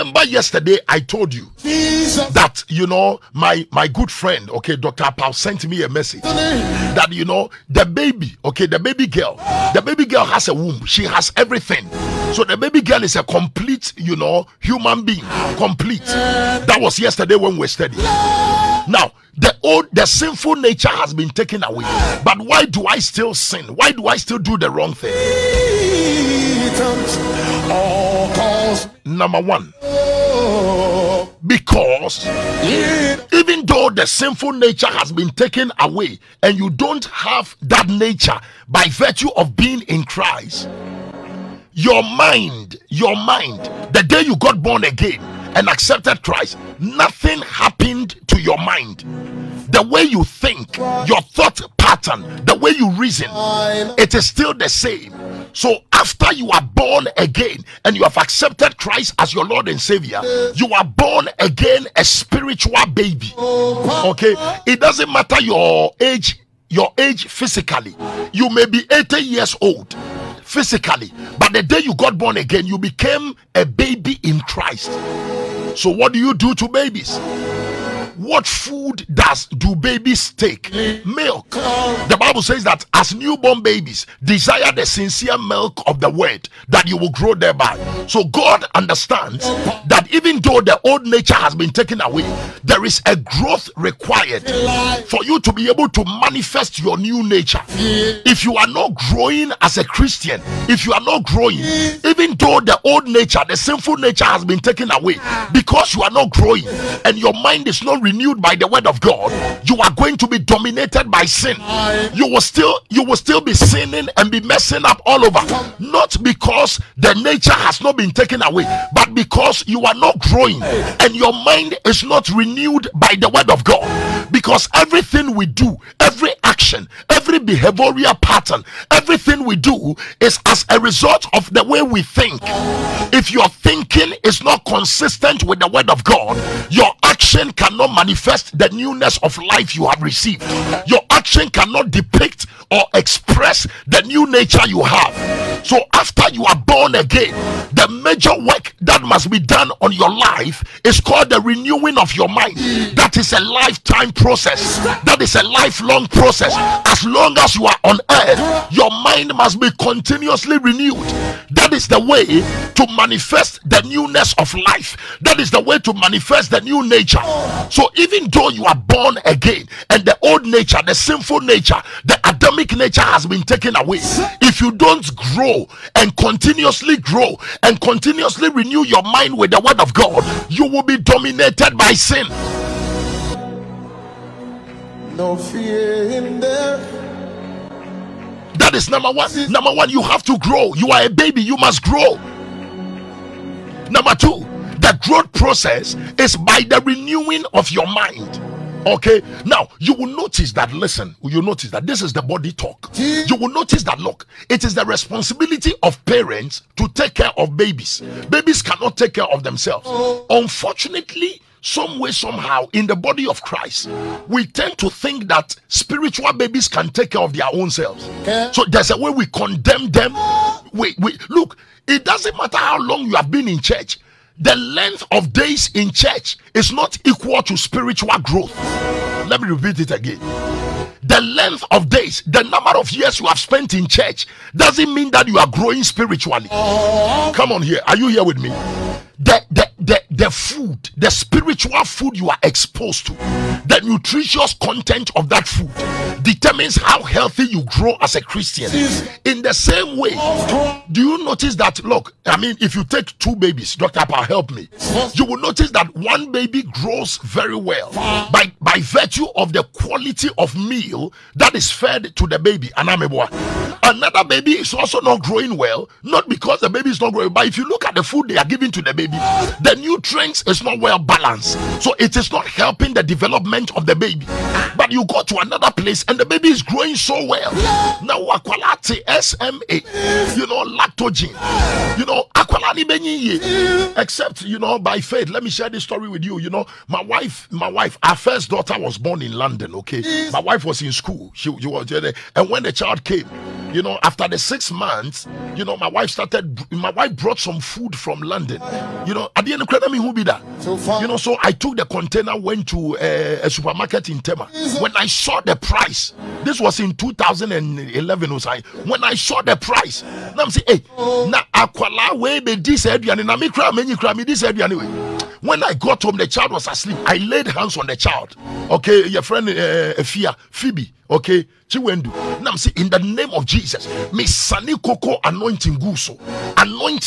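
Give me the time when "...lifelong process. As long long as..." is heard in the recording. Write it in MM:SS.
02:35.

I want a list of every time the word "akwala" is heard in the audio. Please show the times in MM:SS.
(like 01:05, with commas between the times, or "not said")
05:11.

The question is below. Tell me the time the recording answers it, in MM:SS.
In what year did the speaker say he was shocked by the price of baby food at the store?
05:06.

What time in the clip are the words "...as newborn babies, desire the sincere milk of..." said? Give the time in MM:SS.
01:22.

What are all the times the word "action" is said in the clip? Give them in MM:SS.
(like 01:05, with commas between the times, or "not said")
02:06, 02:17, 02:21.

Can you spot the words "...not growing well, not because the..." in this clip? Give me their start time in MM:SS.
04:24.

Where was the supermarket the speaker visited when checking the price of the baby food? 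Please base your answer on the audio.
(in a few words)
Tema.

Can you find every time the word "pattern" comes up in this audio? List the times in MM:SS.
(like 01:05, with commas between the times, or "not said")
00:51, 02:08.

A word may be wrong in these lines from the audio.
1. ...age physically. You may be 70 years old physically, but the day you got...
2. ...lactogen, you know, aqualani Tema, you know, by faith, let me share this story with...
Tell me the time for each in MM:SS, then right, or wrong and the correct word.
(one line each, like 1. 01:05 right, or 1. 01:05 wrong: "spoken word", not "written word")
1. 01:06 wrong: "80", not "70"
2. 04:40 wrong: "Except", not "Tema".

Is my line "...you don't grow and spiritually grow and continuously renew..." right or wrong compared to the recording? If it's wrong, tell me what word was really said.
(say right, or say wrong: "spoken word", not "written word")
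wrong: "continuously", not "spiritually".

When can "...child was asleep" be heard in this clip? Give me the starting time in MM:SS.
05:16.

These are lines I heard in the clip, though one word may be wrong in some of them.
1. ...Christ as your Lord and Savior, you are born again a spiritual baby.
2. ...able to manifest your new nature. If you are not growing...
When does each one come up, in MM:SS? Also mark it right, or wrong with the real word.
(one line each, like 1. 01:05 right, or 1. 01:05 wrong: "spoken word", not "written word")
1. 00:58 right
2. 01:35 right.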